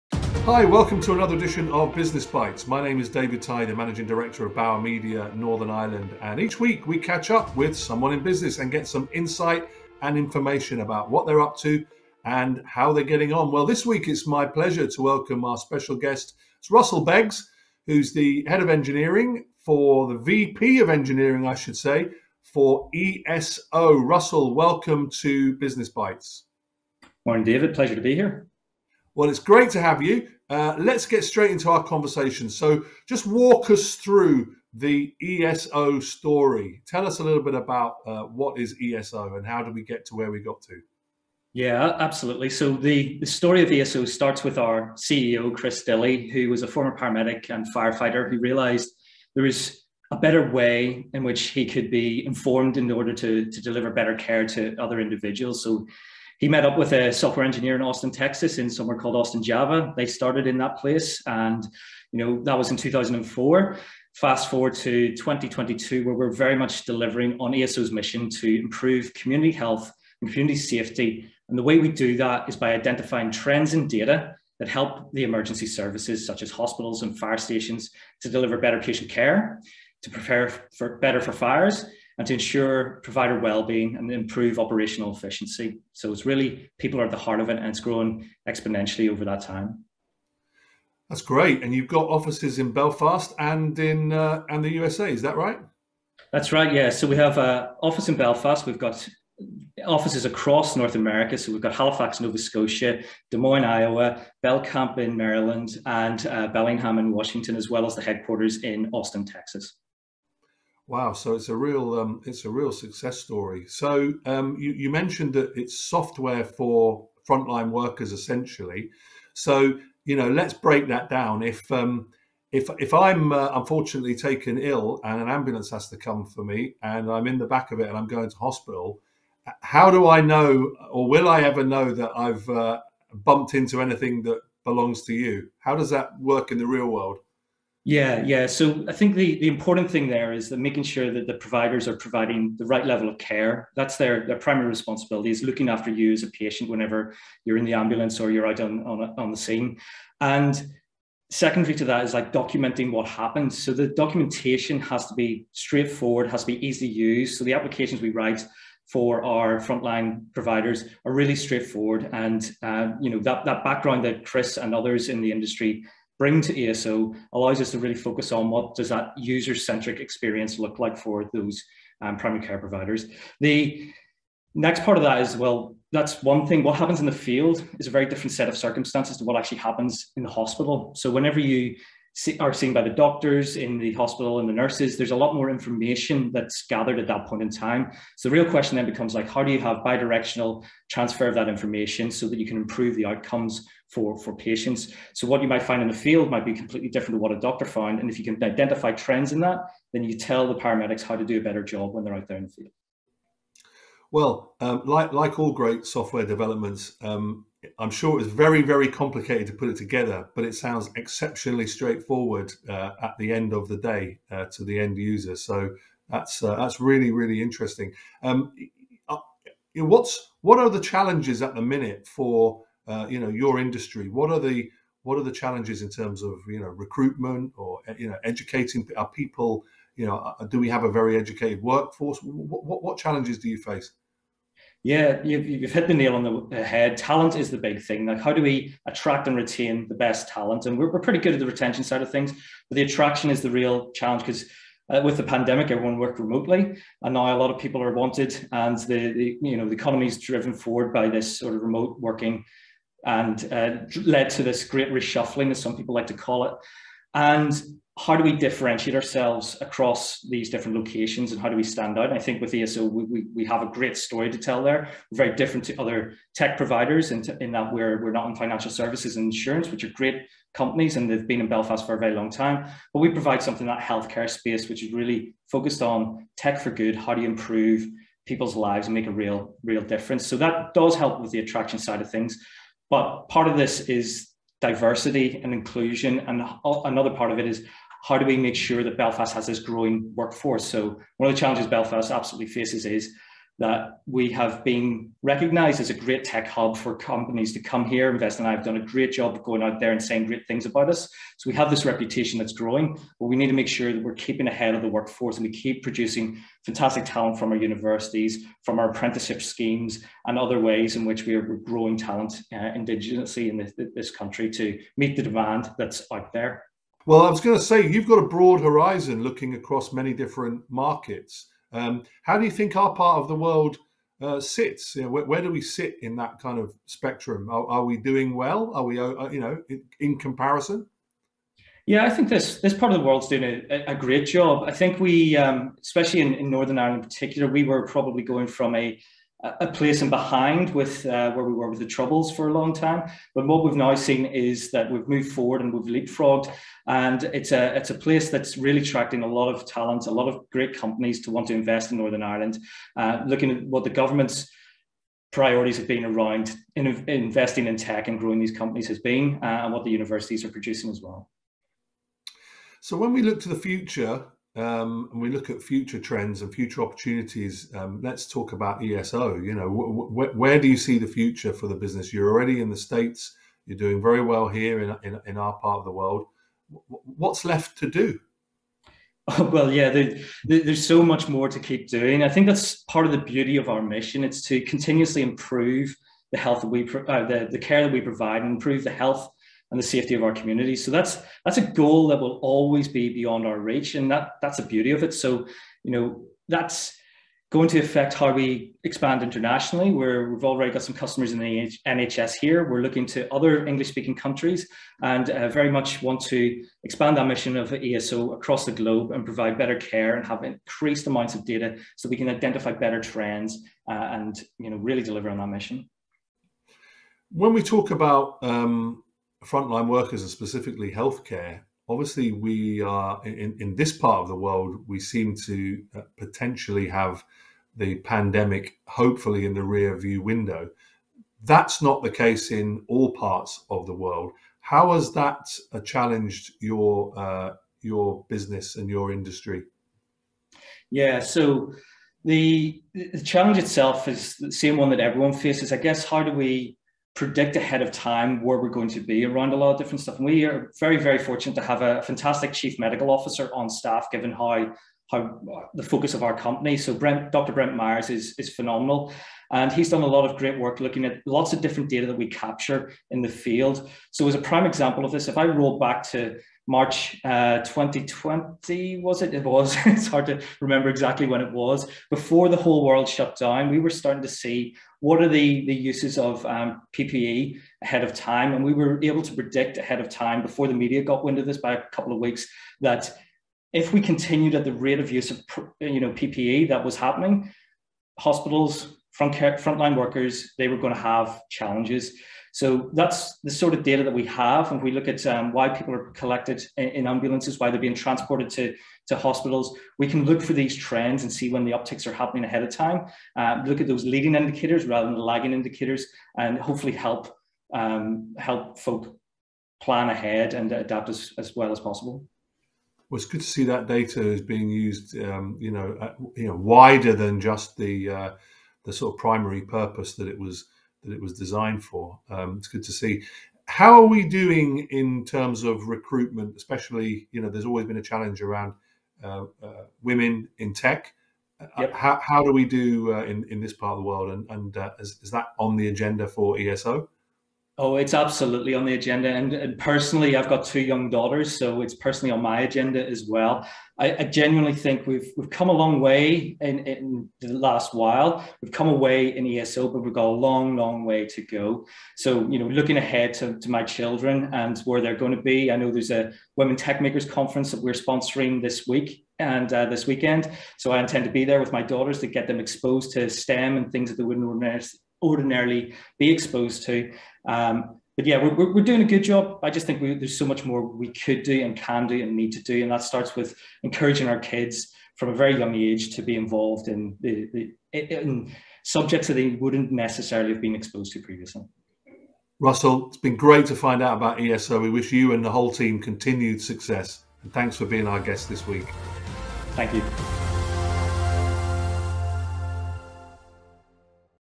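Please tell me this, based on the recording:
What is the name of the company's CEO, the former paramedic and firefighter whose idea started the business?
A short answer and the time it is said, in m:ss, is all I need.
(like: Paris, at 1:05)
Chris Dillie, at 0:45.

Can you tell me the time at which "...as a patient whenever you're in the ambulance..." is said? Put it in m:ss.
2:26.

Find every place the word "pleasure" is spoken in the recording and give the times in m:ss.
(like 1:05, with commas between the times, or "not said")
0:14, 0:27.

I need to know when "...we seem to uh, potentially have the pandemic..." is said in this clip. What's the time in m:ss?
7:04.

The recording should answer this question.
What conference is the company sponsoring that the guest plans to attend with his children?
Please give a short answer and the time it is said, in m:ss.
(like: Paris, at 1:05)
Women Techmakers Conference, at 9:16.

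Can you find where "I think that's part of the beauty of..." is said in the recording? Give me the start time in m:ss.
6:22.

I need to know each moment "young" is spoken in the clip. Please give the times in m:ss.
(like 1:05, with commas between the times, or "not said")
9:00, 9:35.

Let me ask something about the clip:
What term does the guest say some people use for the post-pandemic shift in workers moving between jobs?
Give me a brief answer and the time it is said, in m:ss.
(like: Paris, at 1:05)
great reshuffling, at 4:14.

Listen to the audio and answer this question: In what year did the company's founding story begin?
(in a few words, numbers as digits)
2004.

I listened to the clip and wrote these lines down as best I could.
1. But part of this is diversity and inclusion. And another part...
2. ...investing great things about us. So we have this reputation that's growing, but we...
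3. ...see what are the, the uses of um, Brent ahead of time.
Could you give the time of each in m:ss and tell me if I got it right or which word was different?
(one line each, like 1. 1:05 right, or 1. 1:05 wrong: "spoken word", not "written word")
1. 4:42 right
2. 5:00 wrong: "saying", not "investing"
3. 7:54 wrong: "PPE", not "Brent".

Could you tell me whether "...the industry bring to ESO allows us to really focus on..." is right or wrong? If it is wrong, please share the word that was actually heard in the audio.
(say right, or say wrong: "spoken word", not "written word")
right.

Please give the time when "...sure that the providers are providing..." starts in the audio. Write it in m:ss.
2:20.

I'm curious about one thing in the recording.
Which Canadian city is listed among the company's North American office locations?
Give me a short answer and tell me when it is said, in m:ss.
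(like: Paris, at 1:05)
Halifax, Nova Scotia, at 1:41.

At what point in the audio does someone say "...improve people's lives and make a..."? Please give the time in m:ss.
4:37.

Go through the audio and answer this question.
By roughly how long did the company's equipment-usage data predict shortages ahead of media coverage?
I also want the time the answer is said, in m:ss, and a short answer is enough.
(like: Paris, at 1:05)
a couple of weeks, at 8:01.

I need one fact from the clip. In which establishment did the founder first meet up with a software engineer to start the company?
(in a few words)
Austin Java.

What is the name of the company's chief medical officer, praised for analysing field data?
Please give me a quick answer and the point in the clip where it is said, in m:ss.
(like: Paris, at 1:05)
Dr. Brent Myers, at 7:37.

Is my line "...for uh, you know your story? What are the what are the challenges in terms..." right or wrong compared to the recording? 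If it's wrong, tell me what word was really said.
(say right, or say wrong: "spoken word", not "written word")
wrong: "industry", not "story".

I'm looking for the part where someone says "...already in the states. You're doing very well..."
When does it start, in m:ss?
6:12.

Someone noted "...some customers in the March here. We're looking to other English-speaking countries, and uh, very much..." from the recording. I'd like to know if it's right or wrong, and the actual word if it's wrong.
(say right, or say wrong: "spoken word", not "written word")
wrong: "NHS", not "March".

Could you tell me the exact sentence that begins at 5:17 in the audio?
Well, I was going to say, you've got a broad horizon looking across many different markets.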